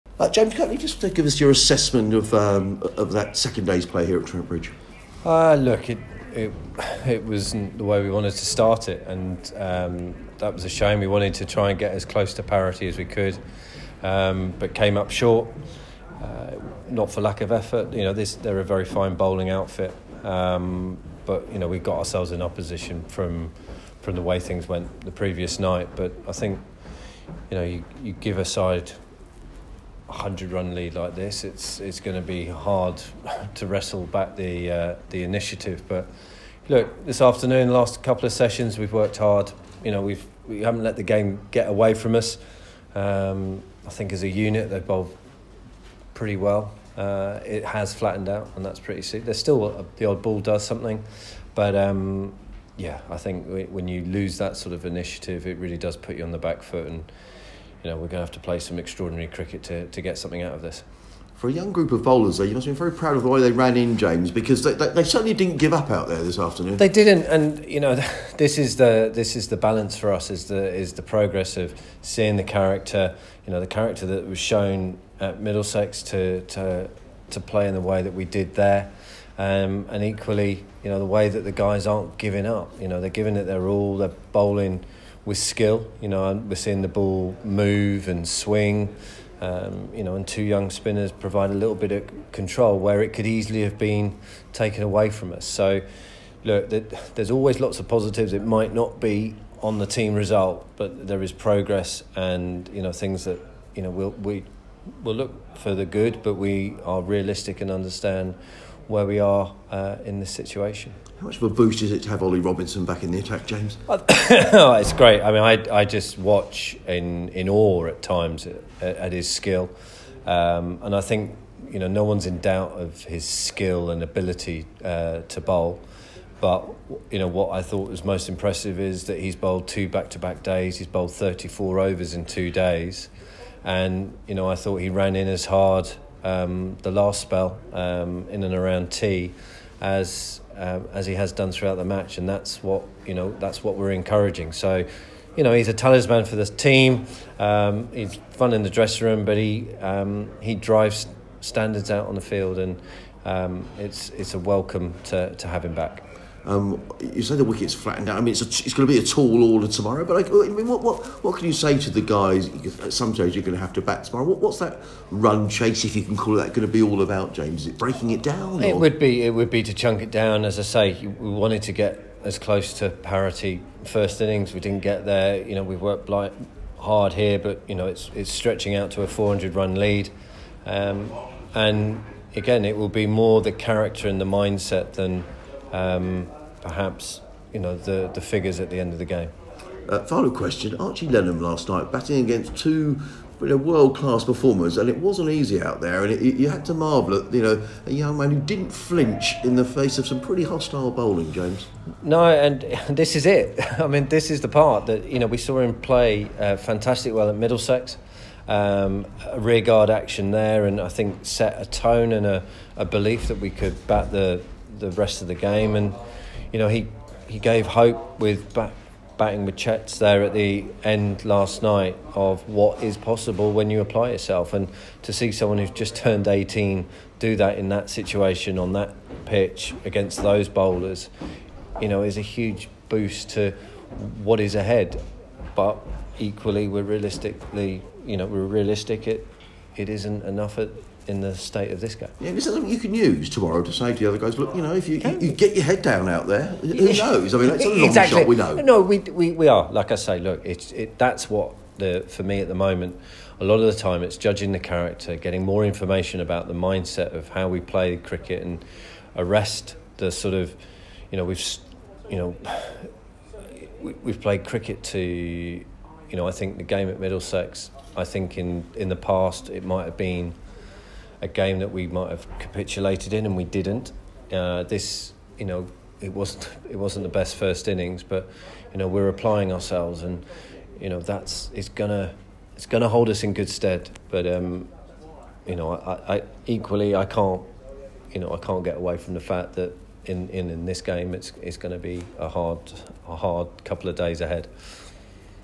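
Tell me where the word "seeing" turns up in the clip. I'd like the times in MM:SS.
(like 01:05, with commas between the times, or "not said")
01:12, 01:26.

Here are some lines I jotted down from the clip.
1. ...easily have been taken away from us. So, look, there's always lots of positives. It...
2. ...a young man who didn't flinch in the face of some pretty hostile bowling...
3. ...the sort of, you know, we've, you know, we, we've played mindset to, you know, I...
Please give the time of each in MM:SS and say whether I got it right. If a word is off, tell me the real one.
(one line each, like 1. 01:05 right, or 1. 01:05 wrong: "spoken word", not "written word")
1. 01:33 right
2. 03:17 right
3. 04:19 wrong: "cricket", not "mindset".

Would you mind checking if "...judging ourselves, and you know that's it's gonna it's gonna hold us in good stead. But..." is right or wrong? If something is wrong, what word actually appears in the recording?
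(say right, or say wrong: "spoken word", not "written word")
wrong: "applying", not "judging".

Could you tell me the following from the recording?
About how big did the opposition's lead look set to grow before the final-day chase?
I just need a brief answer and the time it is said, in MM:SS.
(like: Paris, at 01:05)
400 runs, at 02:59.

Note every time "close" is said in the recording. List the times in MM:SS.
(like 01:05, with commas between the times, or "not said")
00:12, 02:52.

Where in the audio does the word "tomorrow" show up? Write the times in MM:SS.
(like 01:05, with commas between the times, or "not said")
02:39, 02:44, 04:03.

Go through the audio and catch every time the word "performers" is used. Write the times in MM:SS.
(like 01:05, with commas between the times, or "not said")
03:14.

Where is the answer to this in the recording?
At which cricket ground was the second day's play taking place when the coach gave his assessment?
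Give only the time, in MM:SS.
00:04.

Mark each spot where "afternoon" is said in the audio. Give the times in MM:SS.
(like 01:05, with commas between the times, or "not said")
00:37, 01:06.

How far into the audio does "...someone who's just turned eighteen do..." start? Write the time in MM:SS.
03:45.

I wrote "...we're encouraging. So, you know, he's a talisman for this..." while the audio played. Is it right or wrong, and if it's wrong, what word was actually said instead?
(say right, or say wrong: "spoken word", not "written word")
right.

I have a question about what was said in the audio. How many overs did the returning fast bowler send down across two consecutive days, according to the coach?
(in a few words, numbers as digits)
34.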